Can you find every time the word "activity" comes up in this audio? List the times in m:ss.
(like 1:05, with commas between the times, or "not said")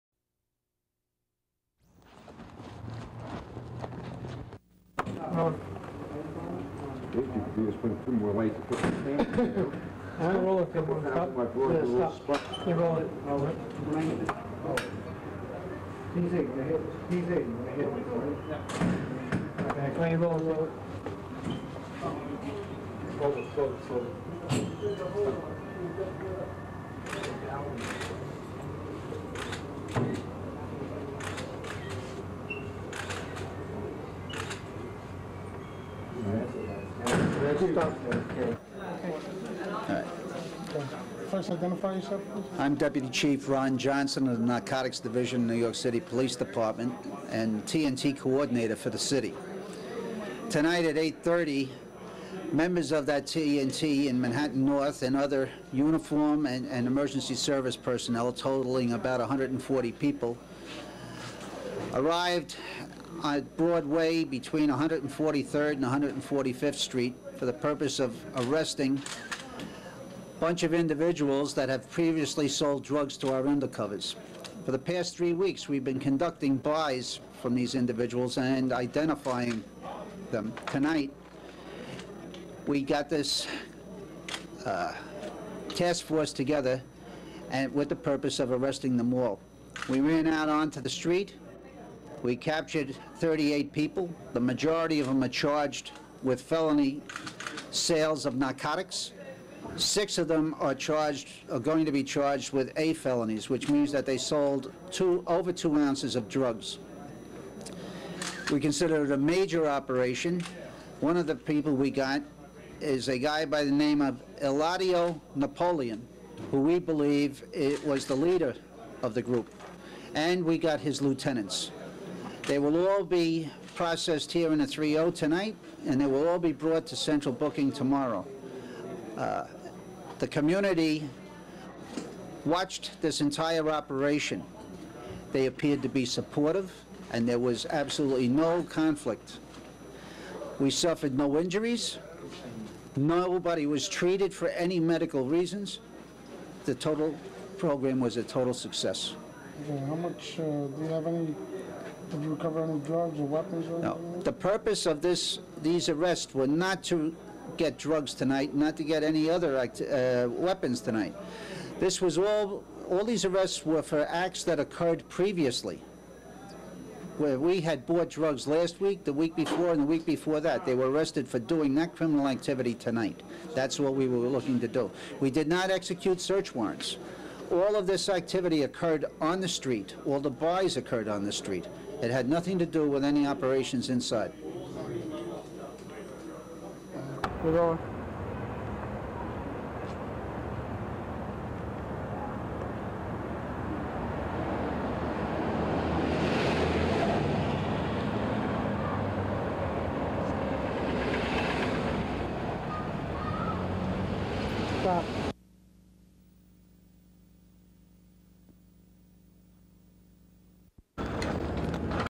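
2:52, 2:58.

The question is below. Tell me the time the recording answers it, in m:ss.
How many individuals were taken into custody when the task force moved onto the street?
1:33.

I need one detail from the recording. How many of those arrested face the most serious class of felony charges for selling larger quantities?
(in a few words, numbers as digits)
6.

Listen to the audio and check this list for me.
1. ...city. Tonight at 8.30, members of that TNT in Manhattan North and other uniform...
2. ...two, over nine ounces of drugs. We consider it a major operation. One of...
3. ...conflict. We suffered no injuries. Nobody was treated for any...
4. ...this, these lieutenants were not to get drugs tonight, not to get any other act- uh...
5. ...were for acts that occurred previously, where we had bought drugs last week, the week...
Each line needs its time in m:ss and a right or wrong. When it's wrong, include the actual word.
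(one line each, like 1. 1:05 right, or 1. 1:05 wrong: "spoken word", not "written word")
1. 0:48 right
2. 1:44 wrong: "two", not "nine"
3. 2:18 right
4. 2:35 wrong: "arrests", not "lieutenants"
5. 2:43 right.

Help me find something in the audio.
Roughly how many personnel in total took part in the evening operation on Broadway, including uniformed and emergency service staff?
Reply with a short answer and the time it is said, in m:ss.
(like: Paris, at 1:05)
140, at 0:58.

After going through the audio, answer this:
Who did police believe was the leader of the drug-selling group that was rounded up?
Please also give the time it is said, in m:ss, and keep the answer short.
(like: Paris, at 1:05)
Eladio Napoleon, at 1:54.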